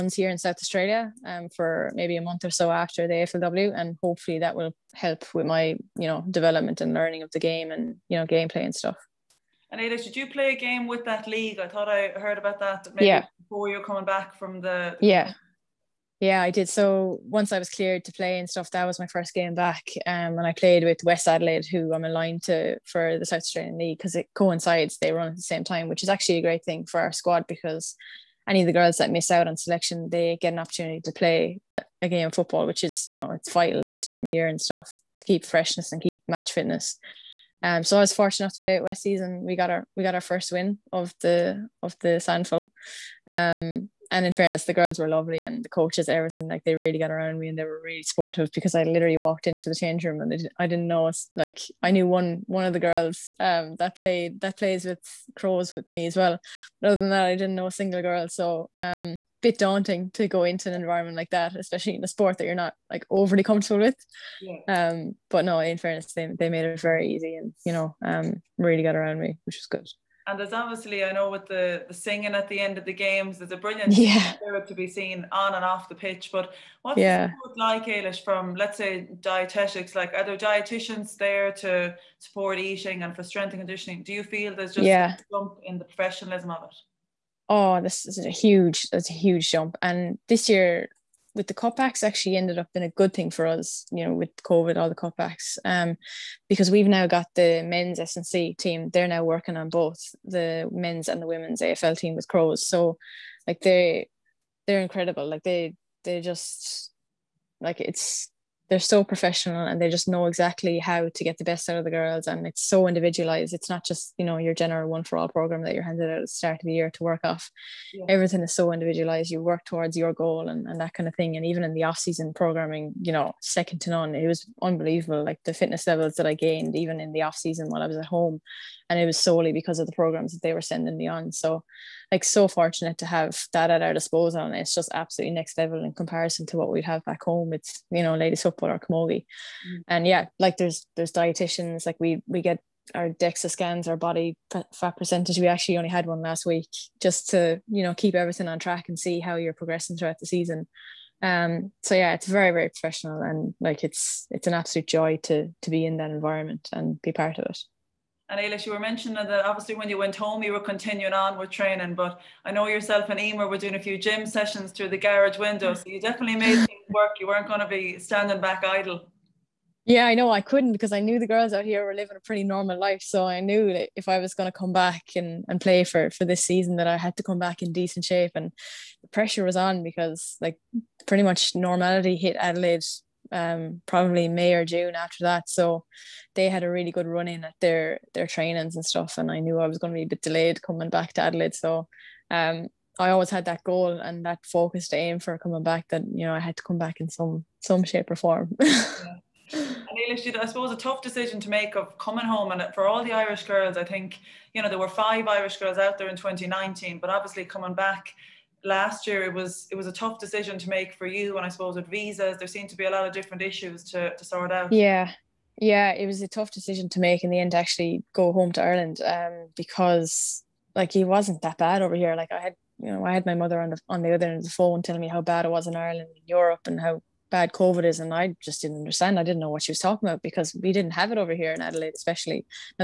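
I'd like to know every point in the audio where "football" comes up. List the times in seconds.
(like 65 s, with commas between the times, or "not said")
32 s, 138 s.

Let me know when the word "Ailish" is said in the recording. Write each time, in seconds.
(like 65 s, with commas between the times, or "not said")
77 s, 158 s.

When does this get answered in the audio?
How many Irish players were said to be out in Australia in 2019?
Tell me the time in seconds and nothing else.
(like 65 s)
204 s.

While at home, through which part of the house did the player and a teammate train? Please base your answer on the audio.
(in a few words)
garage window.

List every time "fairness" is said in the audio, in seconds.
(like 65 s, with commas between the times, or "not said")
44 s, 65 s.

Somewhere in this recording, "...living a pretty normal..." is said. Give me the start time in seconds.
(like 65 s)
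171 s.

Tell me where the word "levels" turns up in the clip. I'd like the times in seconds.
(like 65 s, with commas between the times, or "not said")
125 s, 135 s.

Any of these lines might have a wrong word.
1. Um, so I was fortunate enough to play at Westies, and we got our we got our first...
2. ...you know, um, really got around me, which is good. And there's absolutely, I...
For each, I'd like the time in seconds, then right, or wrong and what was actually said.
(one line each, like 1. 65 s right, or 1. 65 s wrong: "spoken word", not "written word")
1. 37 s right
2. 67 s wrong: "obviously", not "absolutely".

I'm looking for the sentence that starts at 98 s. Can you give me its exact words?
They're now working on both the men's and the women's AFL team with Crows.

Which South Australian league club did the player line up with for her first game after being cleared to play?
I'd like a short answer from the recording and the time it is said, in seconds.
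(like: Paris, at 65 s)
West Adelaide, at 21 s.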